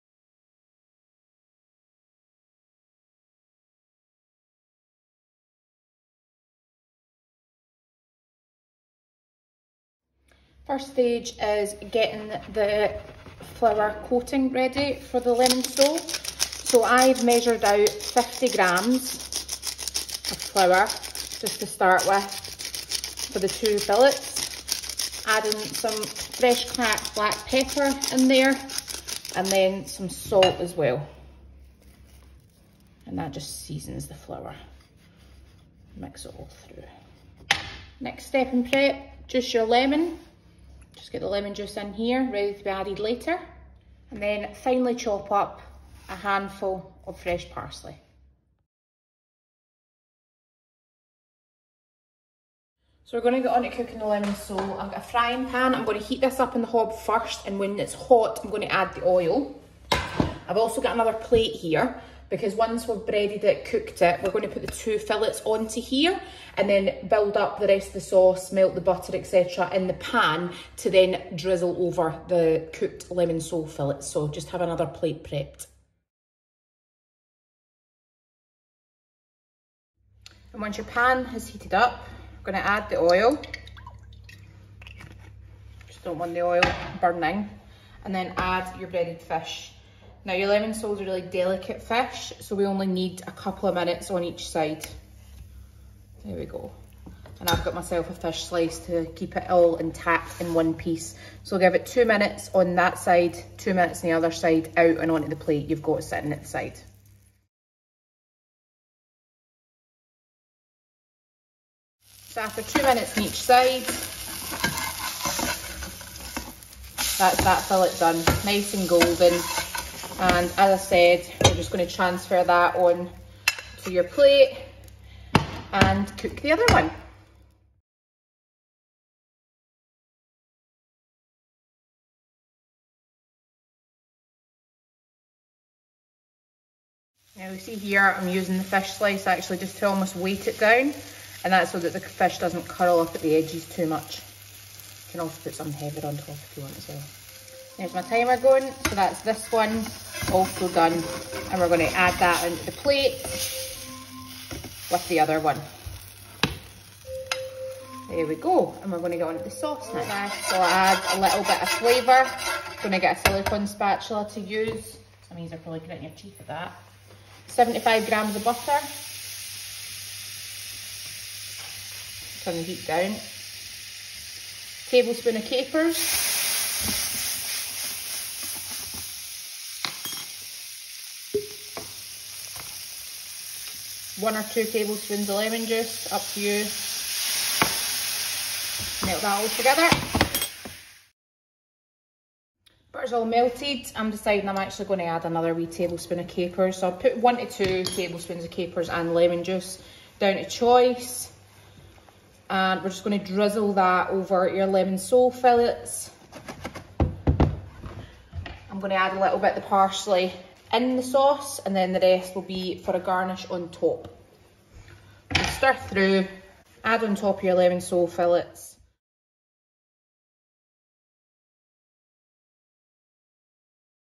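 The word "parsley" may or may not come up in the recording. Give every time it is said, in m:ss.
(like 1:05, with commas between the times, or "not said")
0:47, 3:29.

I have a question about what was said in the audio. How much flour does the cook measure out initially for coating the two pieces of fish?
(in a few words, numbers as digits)
50 grams.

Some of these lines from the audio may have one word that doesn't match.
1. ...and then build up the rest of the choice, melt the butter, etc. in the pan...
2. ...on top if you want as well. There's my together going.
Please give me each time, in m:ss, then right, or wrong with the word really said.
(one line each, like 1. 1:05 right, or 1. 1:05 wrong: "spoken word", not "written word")
1. 1:06 wrong: "sauce", not "choice"
2. 2:26 wrong: "timer", not "together".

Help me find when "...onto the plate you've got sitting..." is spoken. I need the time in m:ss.
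1:45.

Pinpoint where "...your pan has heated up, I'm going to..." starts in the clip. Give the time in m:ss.
1:20.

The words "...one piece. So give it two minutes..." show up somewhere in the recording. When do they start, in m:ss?
1:40.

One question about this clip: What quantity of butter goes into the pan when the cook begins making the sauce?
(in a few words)
75 grams.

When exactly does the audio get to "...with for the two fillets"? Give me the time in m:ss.
0:22.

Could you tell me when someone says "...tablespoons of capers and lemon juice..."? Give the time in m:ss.
3:17.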